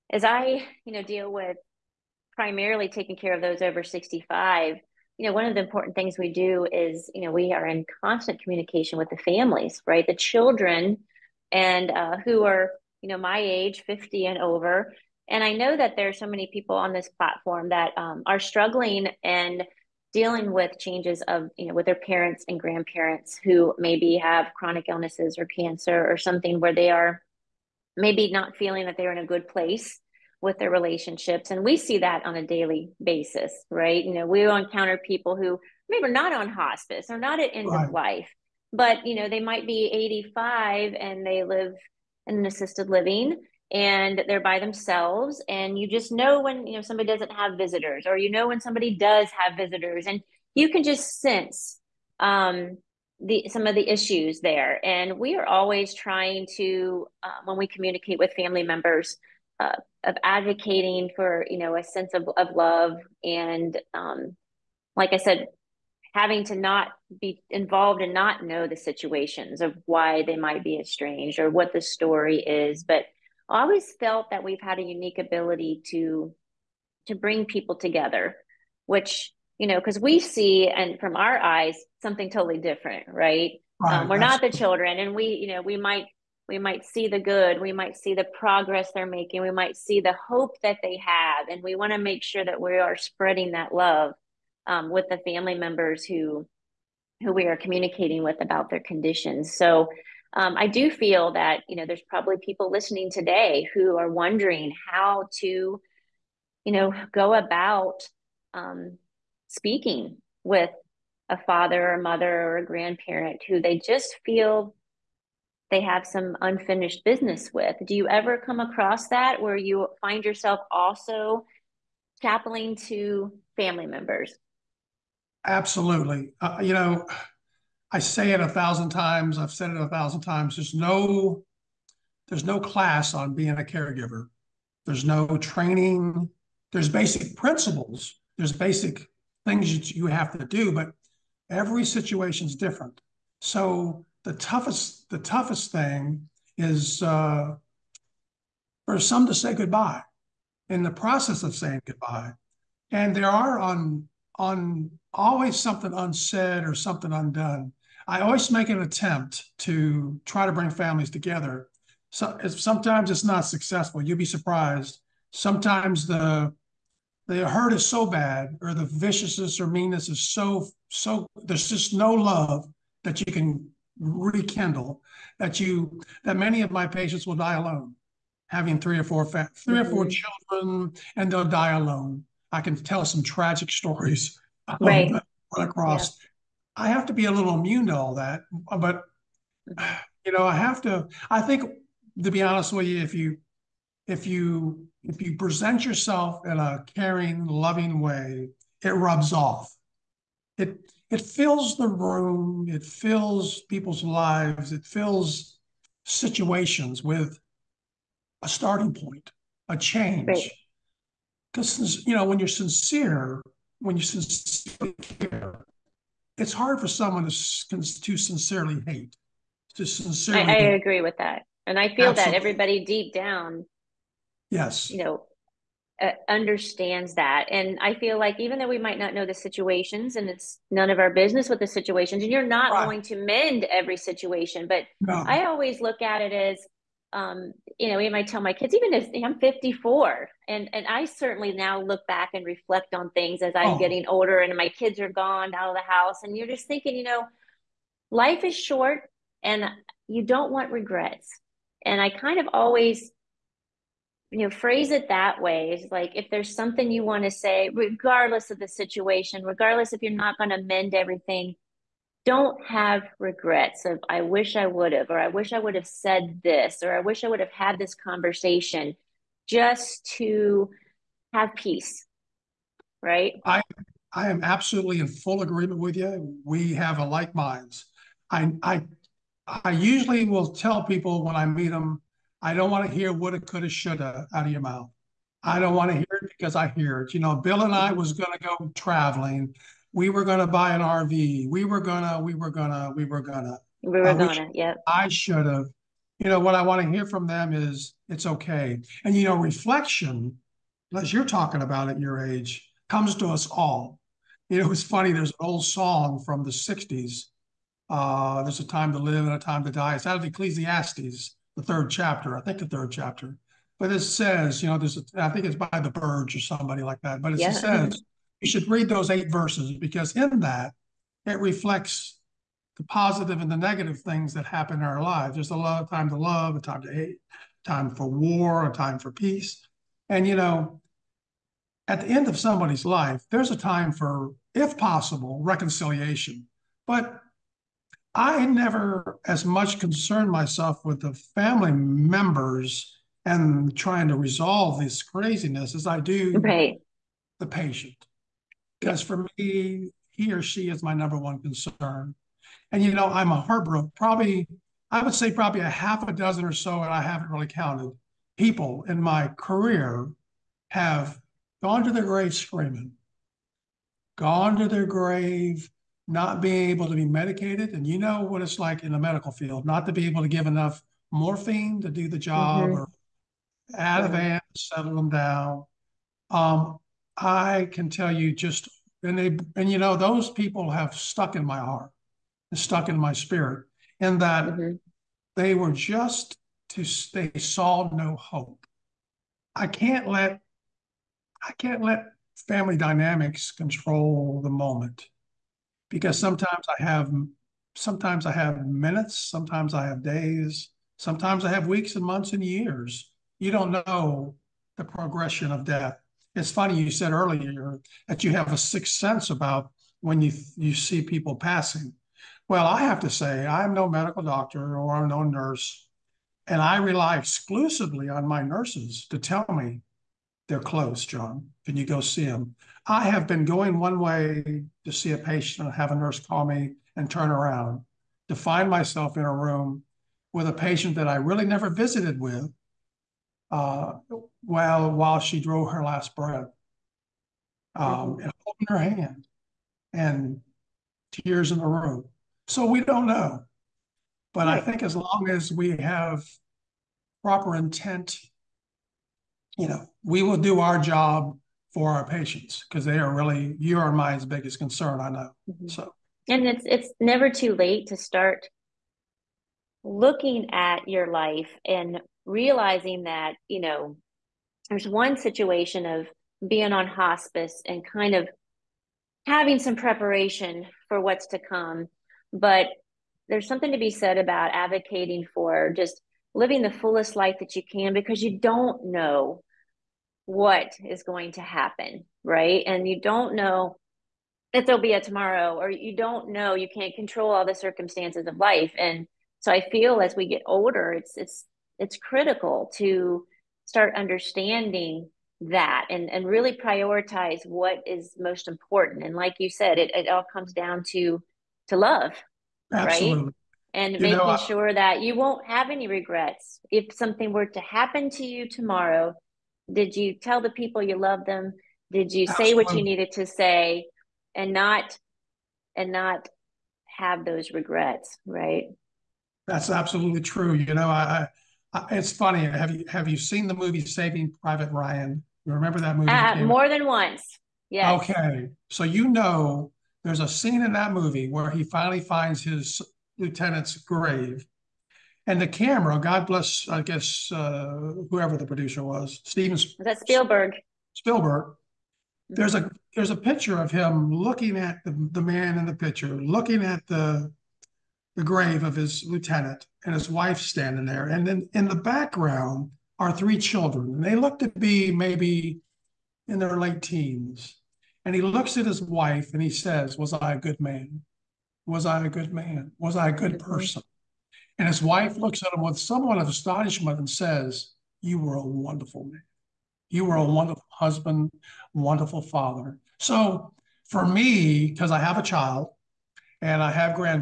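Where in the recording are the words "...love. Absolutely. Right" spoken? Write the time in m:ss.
8:21.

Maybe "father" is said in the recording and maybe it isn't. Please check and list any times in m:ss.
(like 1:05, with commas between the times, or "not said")
1:51, 9:32.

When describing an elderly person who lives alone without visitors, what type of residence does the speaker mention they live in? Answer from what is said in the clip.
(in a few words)
assisted living.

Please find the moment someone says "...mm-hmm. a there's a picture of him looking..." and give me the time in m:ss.
9:02.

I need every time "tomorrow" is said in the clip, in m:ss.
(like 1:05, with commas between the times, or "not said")
8:04, 8:28.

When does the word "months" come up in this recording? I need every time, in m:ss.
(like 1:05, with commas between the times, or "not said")
6:42.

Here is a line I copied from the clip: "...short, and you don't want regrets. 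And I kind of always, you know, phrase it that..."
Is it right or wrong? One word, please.
right.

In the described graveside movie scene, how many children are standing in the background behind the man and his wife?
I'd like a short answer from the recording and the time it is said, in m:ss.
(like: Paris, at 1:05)
3, at 9:13.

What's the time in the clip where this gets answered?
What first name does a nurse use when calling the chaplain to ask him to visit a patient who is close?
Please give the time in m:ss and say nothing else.
7:01.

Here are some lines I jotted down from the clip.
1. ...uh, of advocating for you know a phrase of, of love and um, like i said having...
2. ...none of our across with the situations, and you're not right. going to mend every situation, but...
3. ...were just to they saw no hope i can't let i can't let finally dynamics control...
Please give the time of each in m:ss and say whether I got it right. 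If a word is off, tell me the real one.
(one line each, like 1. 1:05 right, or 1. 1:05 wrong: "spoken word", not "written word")
1. 0:59 wrong: "sense", not "phrase"
2. 3:50 wrong: "business", not "across"
3. 6:25 wrong: "family", not "finally".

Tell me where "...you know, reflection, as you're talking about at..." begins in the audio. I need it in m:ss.
4:59.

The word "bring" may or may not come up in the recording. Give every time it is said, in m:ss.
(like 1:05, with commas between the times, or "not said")
1:17, 2:40.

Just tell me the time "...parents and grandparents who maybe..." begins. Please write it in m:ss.
0:21.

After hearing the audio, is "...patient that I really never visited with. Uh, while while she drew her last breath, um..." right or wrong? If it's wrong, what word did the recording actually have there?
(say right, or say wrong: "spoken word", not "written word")
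right.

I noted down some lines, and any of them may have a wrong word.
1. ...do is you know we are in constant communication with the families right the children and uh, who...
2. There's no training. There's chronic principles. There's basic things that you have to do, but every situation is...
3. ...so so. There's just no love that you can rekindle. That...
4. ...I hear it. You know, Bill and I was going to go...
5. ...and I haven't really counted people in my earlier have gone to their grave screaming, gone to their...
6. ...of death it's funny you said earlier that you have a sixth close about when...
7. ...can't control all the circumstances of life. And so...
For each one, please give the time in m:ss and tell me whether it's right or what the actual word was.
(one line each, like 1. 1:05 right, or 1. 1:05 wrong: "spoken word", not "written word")
1. 0:06 right
2. 2:14 wrong: "basic", not "chronic"
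3. 2:50 right
4. 4:46 right
5. 5:56 wrong: "career", not "earlier"
6. 6:45 wrong: "sense", not "close"
7. 8:06 right.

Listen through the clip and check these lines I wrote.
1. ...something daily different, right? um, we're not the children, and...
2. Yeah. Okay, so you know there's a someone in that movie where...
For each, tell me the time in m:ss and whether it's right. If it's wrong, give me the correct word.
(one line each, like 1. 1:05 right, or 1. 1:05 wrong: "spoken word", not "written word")
1. 1:22 wrong: "totally", not "daily"
2. 8:47 wrong: "scene", not "someone".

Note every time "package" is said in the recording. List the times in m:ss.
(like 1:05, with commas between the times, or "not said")
not said.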